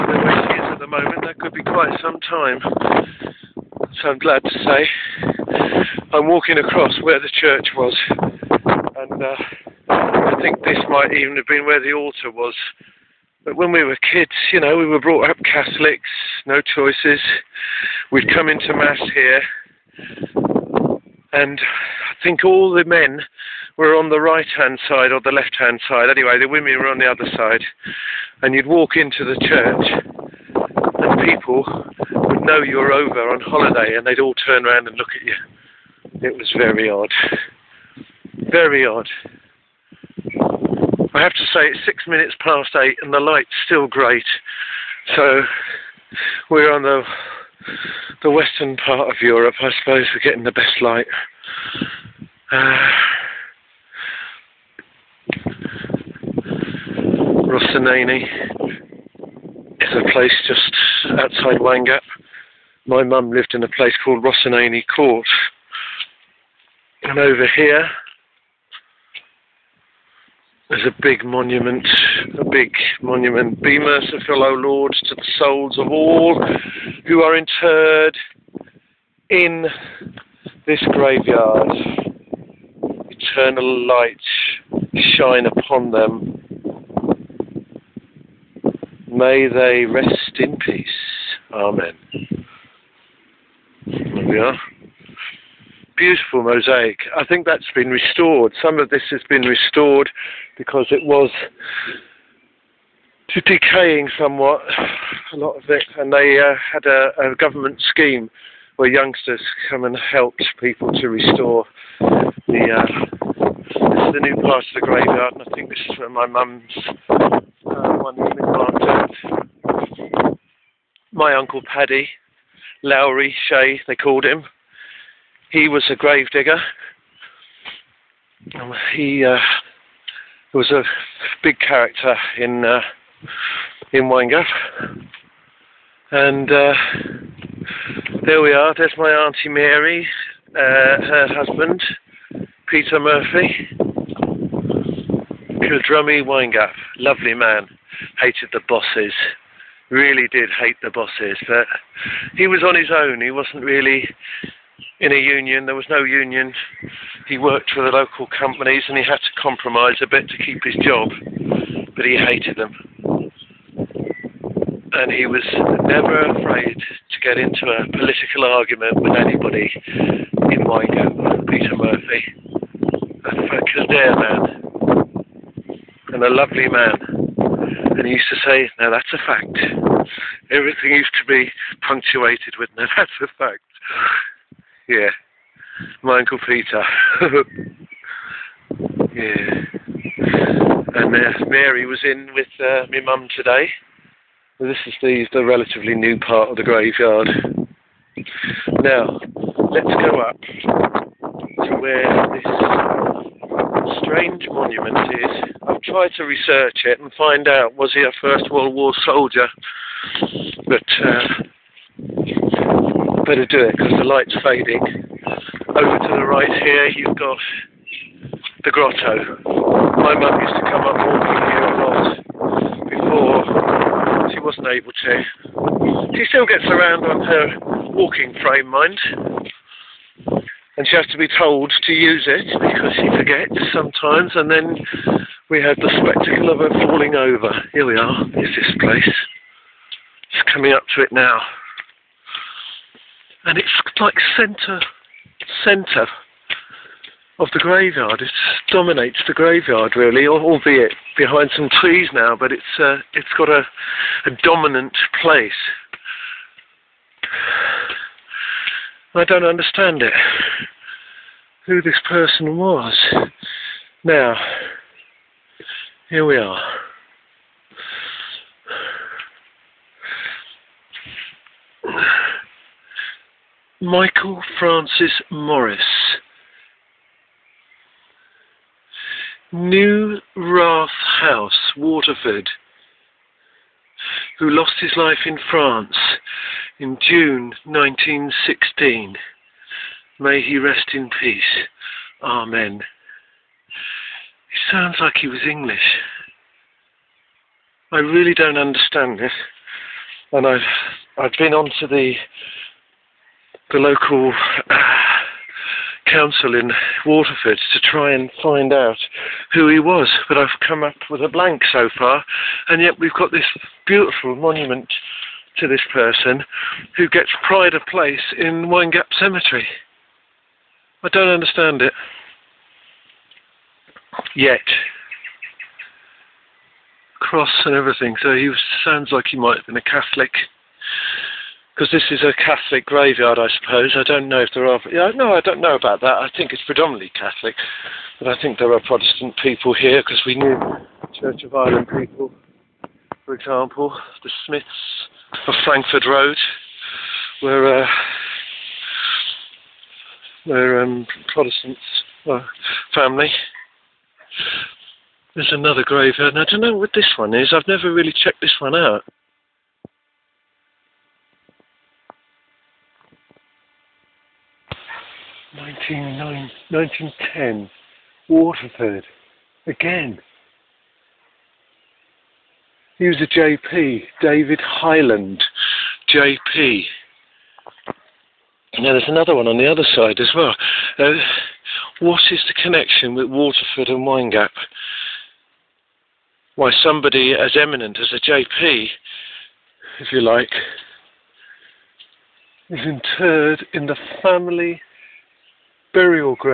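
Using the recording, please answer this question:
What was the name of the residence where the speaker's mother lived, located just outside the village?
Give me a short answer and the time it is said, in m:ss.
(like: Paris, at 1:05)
Rossinani Court, at 1:04.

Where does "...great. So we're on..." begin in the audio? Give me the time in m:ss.
0:43.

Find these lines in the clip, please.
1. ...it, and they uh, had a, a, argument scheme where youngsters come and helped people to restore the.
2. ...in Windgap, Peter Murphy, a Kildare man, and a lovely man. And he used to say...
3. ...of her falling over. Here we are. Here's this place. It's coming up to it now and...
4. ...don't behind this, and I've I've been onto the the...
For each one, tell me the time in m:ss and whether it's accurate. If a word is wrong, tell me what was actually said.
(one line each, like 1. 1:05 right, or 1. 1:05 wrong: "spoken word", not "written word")
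1. 1:45 wrong: "government", not "argument"
2. 2:49 right
3. 3:56 right
4. 4:58 wrong: "understand", not "behind".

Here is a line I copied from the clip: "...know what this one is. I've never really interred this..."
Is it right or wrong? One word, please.
wrong.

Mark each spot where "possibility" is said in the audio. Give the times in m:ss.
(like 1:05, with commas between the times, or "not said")
not said.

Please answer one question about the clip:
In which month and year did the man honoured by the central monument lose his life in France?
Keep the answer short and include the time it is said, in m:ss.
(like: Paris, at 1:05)
June 1916, at 4:47.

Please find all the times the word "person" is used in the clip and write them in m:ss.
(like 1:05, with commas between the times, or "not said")
4:22, 5:15.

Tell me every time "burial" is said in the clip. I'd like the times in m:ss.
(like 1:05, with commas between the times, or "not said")
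6:35.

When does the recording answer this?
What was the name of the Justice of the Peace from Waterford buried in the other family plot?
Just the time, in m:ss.
6:14.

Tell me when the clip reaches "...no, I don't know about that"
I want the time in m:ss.
5:35.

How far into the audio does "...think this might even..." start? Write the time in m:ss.
0:10.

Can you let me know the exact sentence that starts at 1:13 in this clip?
Be merciful, O Lord, to the souls of all who are interred in this graveyard.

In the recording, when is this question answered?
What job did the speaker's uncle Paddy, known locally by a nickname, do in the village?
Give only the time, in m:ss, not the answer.
2:05.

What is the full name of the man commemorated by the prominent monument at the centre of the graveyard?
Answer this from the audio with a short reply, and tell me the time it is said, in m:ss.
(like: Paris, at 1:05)
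Michael Francis Morris, at 4:33.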